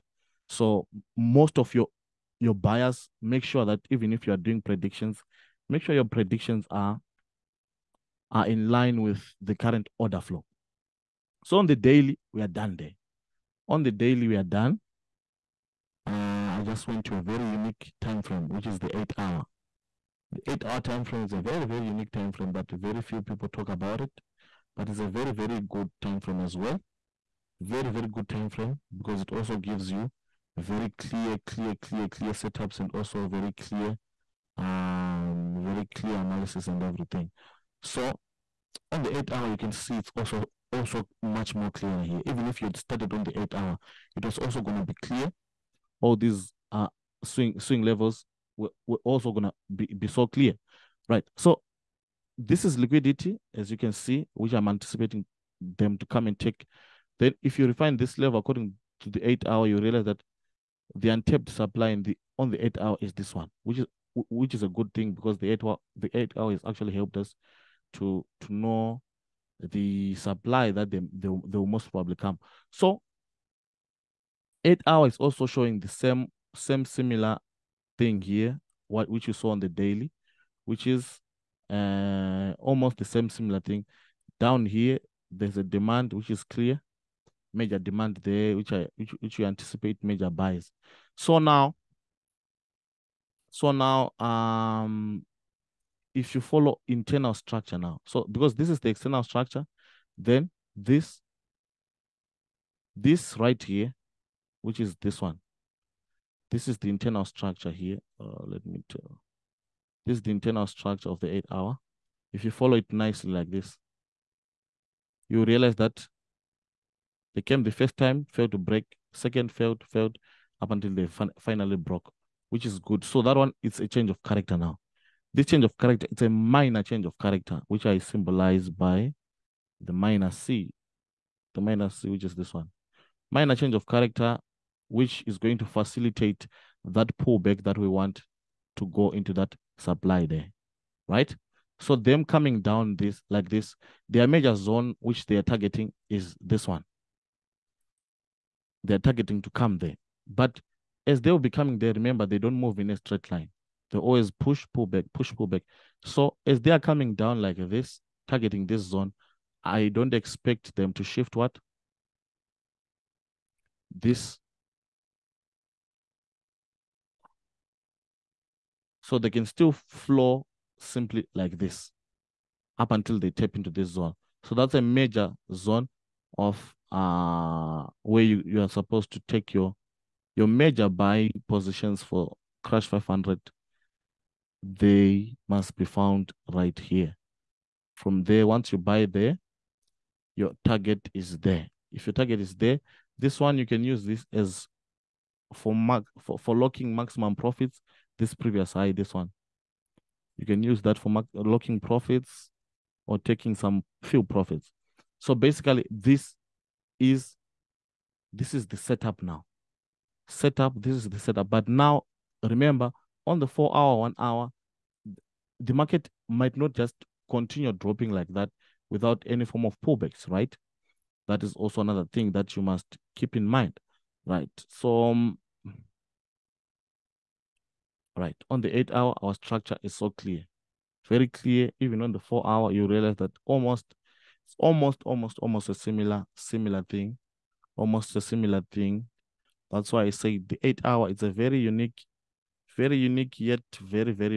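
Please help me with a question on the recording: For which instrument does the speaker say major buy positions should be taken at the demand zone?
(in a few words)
Crash 500.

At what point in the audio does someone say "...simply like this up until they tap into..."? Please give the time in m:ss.
2:50.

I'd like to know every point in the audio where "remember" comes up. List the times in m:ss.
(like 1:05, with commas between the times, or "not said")
2:31, 3:32.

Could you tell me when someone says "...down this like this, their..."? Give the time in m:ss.
2:22.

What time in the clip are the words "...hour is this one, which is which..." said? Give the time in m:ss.
1:02.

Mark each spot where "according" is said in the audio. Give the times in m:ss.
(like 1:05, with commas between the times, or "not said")
0:58.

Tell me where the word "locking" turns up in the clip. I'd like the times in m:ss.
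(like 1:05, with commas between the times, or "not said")
3:16, 3:21.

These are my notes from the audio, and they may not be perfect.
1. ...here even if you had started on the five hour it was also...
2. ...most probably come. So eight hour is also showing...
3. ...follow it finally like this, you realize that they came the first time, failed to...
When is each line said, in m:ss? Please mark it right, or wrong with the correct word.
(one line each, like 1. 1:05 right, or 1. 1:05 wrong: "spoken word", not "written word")
1. 0:42 wrong: "eight", not "five"
2. 1:11 right
3. 1:52 wrong: "nicely", not "finally".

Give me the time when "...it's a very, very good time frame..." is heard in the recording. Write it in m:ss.
0:24.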